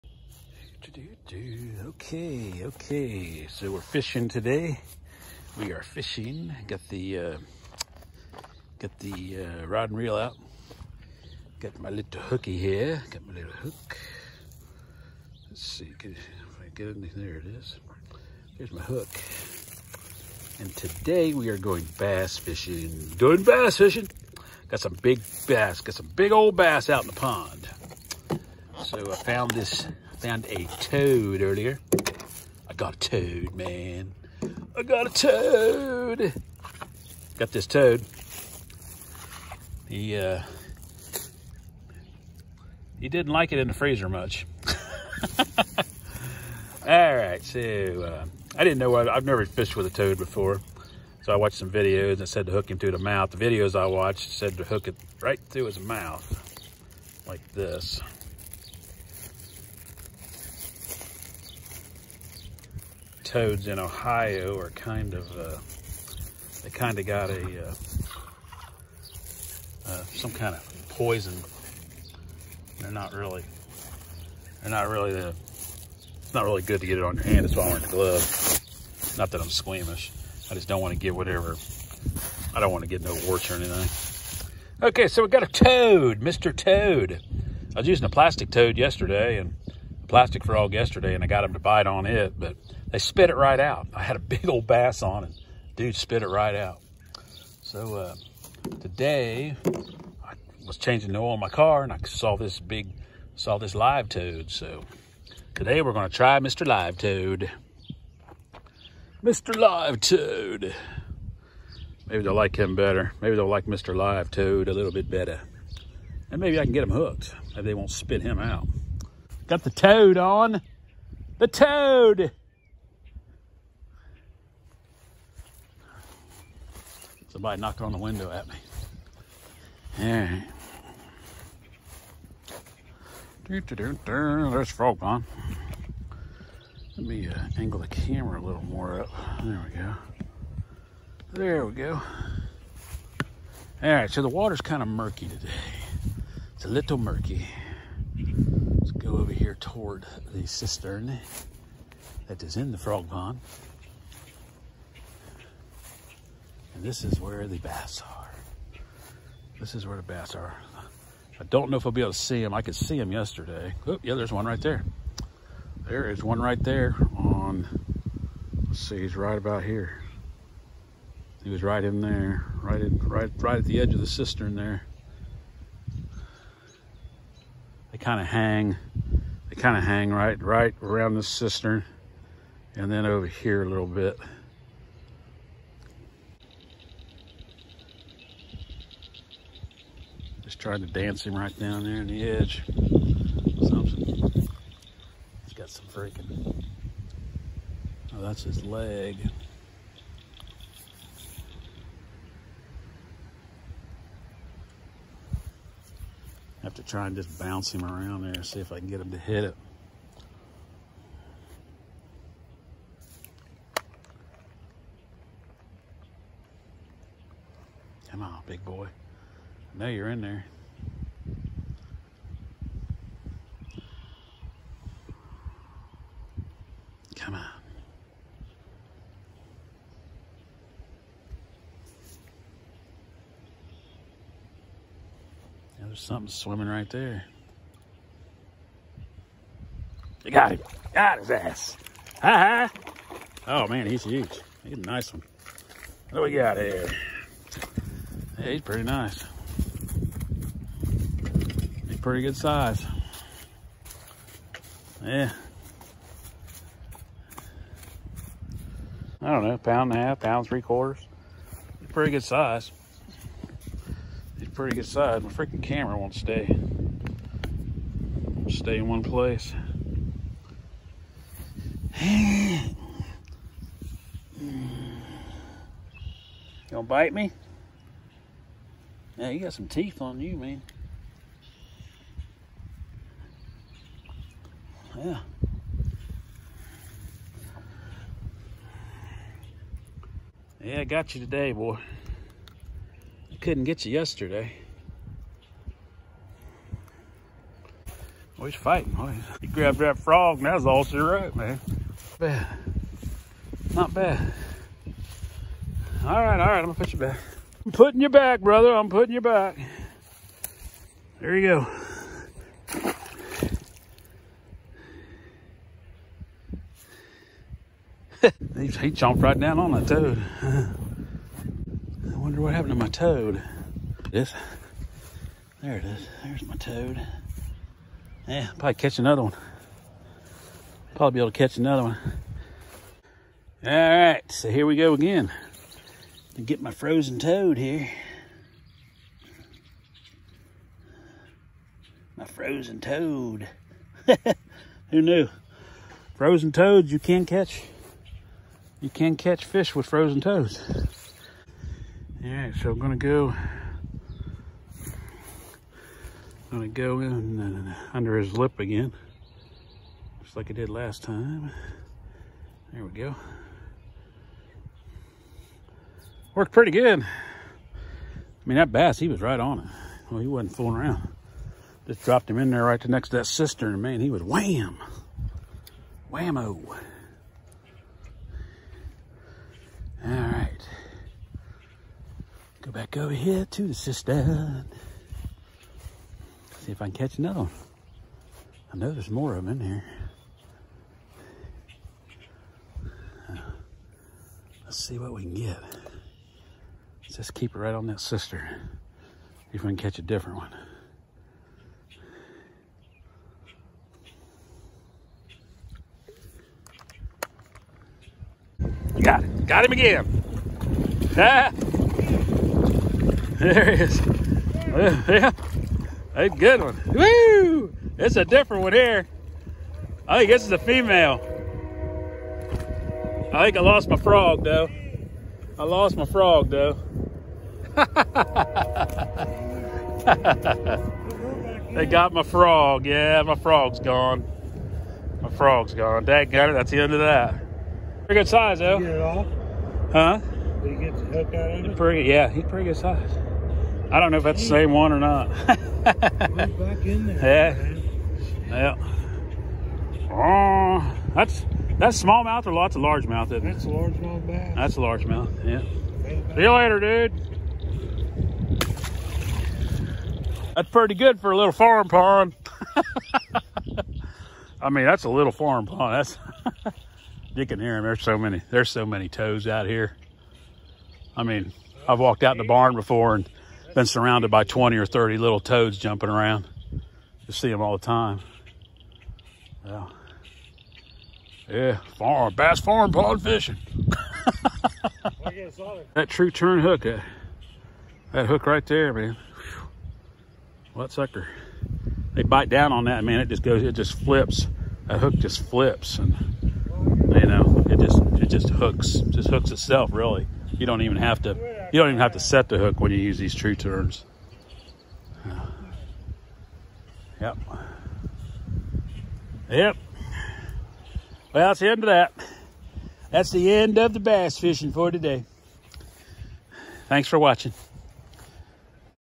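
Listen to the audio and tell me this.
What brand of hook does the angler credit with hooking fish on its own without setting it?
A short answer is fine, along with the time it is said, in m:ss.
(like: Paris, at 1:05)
Tru-Turn, at 8:06.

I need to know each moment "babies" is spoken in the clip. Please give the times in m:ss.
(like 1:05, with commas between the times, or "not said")
not said.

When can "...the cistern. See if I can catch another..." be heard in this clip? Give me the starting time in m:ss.
6:23.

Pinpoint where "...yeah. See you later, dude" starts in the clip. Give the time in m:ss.
7:35.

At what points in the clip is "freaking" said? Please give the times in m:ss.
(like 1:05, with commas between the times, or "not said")
3:15, 4:25.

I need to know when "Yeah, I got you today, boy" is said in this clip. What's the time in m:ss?
4:50.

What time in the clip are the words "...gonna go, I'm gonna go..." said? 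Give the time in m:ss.
5:52.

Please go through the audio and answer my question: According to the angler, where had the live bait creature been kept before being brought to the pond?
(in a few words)
freezer.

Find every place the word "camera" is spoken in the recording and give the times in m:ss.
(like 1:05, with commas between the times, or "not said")
2:17, 4:25.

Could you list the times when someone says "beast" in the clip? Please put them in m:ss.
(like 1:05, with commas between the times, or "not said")
not said.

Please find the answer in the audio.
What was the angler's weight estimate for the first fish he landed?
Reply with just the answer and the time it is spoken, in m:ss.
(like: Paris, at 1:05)
pound and a half, at 4:19.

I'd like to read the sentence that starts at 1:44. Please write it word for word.
So today we're gonna try Mr.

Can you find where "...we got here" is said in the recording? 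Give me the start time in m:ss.
4:06.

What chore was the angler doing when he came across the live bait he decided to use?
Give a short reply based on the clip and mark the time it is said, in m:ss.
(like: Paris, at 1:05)
changing the oil, at 1:40.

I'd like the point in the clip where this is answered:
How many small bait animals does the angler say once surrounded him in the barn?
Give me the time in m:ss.
7:54.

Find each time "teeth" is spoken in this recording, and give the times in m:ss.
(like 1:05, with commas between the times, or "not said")
4:39.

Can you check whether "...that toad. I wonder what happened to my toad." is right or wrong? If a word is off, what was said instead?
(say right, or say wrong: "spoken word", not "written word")
right.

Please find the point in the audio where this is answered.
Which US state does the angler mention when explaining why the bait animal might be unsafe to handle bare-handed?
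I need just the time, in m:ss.
1:03.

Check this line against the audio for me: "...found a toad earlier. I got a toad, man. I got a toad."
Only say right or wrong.
right.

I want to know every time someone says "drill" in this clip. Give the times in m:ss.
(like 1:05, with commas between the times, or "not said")
not said.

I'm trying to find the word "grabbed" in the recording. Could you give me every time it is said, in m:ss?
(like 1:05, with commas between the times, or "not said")
4:59.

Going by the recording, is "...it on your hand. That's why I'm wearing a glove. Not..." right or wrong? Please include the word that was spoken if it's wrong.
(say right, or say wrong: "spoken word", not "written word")
right.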